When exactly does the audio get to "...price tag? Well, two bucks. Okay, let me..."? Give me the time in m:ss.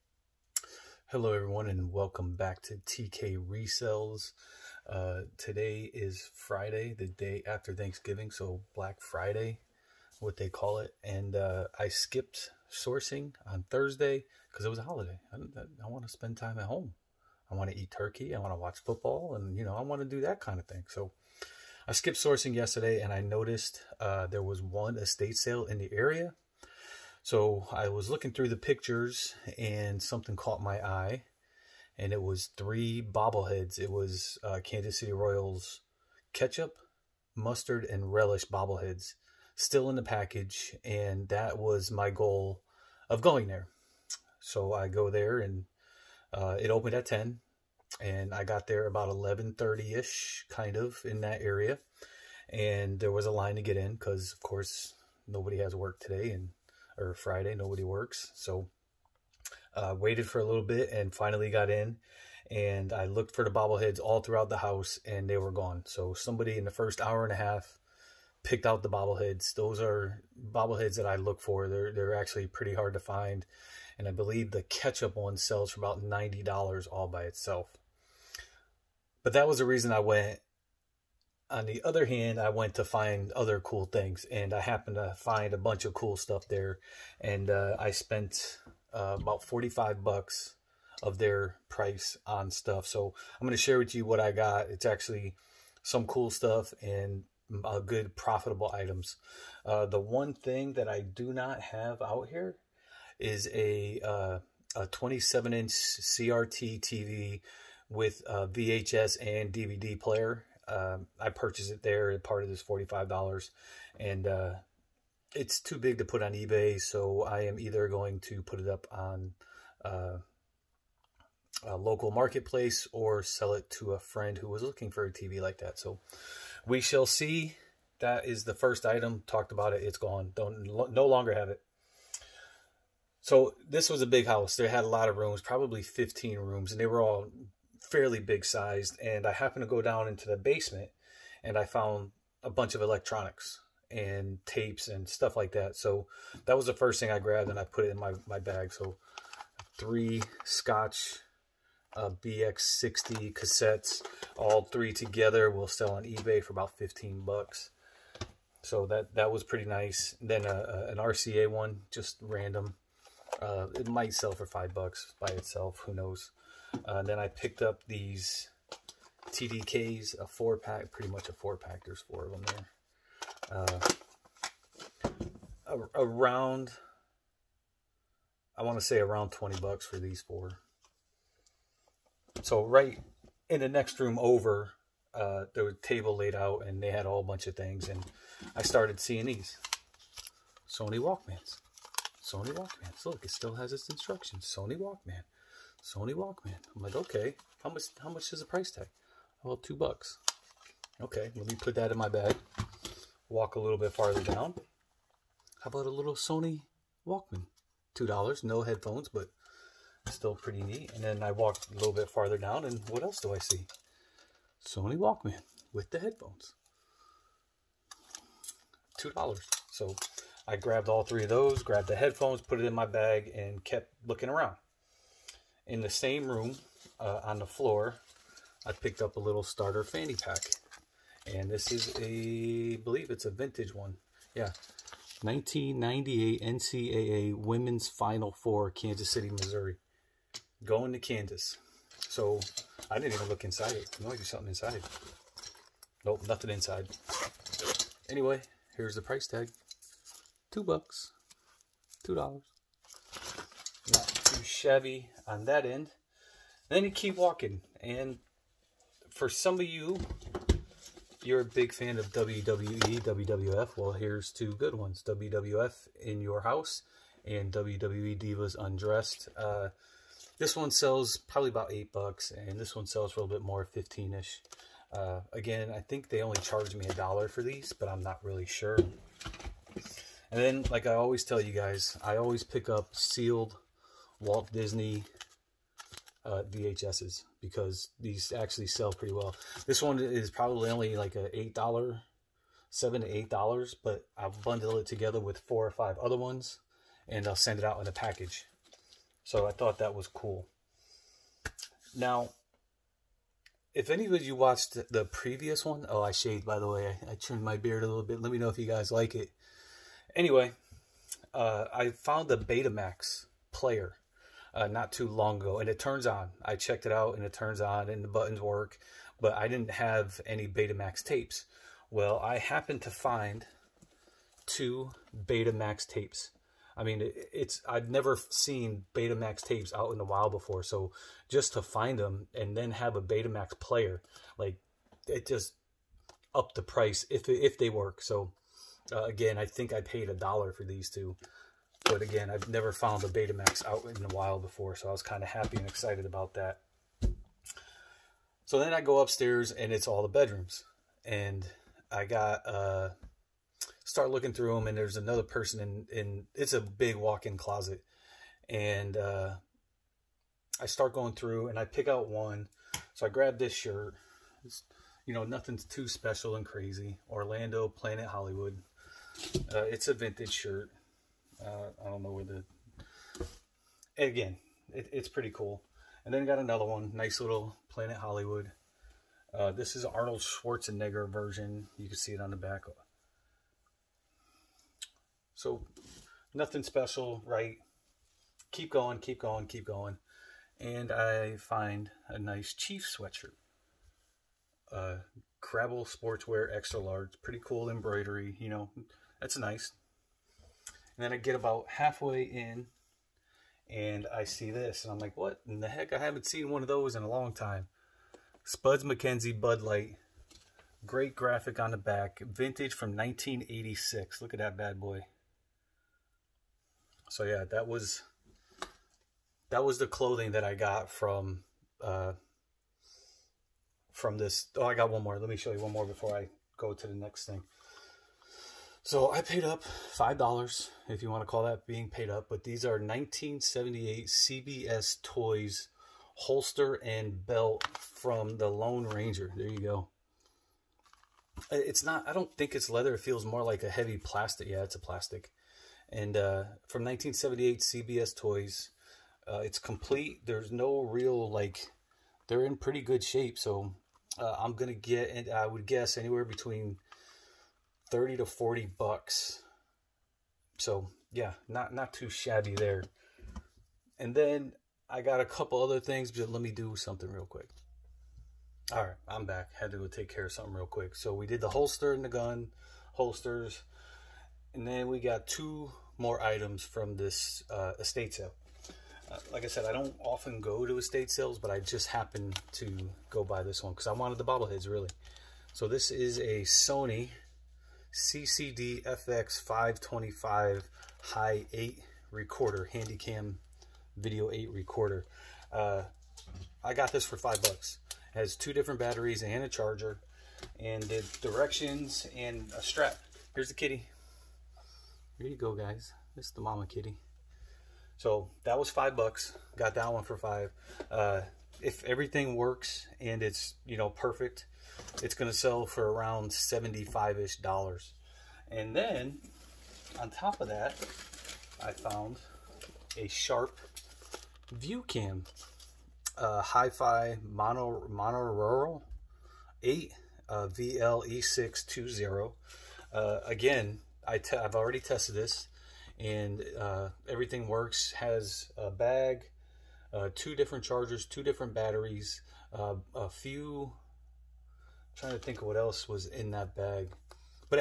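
3:18.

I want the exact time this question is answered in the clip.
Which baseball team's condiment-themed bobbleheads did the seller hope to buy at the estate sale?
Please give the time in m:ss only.
0:34.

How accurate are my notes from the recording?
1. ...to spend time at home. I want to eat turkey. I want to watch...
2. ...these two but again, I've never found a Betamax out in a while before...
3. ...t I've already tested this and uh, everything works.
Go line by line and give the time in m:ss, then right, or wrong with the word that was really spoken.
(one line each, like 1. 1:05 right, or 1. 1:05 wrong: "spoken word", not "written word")
1. 0:16 right
2. 5:40 right
3. 8:54 right.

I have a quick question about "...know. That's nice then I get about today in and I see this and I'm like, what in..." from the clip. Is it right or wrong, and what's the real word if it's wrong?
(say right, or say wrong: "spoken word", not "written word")
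wrong: "halfway", not "today".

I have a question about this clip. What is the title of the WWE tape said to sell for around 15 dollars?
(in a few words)
Divas Undressed.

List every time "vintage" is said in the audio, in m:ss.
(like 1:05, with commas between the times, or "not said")
3:53, 6:09, 6:52.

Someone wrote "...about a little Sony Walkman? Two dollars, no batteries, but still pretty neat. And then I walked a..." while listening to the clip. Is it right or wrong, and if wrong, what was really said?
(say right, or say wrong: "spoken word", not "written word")
wrong: "headphones", not "batteries".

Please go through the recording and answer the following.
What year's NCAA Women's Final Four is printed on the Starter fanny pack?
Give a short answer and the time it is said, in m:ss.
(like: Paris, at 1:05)
1998, at 3:55.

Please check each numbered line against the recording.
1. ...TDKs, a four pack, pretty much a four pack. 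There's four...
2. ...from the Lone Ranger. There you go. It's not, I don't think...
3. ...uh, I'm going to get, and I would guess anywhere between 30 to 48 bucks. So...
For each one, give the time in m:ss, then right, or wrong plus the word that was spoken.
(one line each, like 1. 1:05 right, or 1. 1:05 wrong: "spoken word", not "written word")
1. 2:49 right
2. 7:17 right
3. 7:34 wrong: "40", not "48".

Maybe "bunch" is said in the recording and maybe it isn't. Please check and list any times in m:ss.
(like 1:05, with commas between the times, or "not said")
1:25, 2:22, 3:07.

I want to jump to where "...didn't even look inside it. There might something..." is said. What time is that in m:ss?
4:02.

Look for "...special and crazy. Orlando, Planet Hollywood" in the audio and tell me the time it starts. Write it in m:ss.
6:05.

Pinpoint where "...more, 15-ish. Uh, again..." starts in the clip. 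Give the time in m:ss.
4:33.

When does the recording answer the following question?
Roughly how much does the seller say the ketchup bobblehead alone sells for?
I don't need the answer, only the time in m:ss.
1:16.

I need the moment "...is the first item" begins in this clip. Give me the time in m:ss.
2:08.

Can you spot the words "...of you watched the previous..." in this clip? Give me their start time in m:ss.
5:04.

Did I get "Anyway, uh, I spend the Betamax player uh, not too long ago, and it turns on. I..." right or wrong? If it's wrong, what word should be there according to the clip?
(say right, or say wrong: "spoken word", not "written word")
wrong: "found", not "spend".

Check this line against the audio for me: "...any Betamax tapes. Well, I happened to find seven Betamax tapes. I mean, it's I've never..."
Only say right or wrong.
wrong.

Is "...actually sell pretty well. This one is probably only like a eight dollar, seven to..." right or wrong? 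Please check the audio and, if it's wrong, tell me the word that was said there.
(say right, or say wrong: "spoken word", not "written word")
right.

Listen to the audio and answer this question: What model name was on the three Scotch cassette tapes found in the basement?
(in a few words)
BX60.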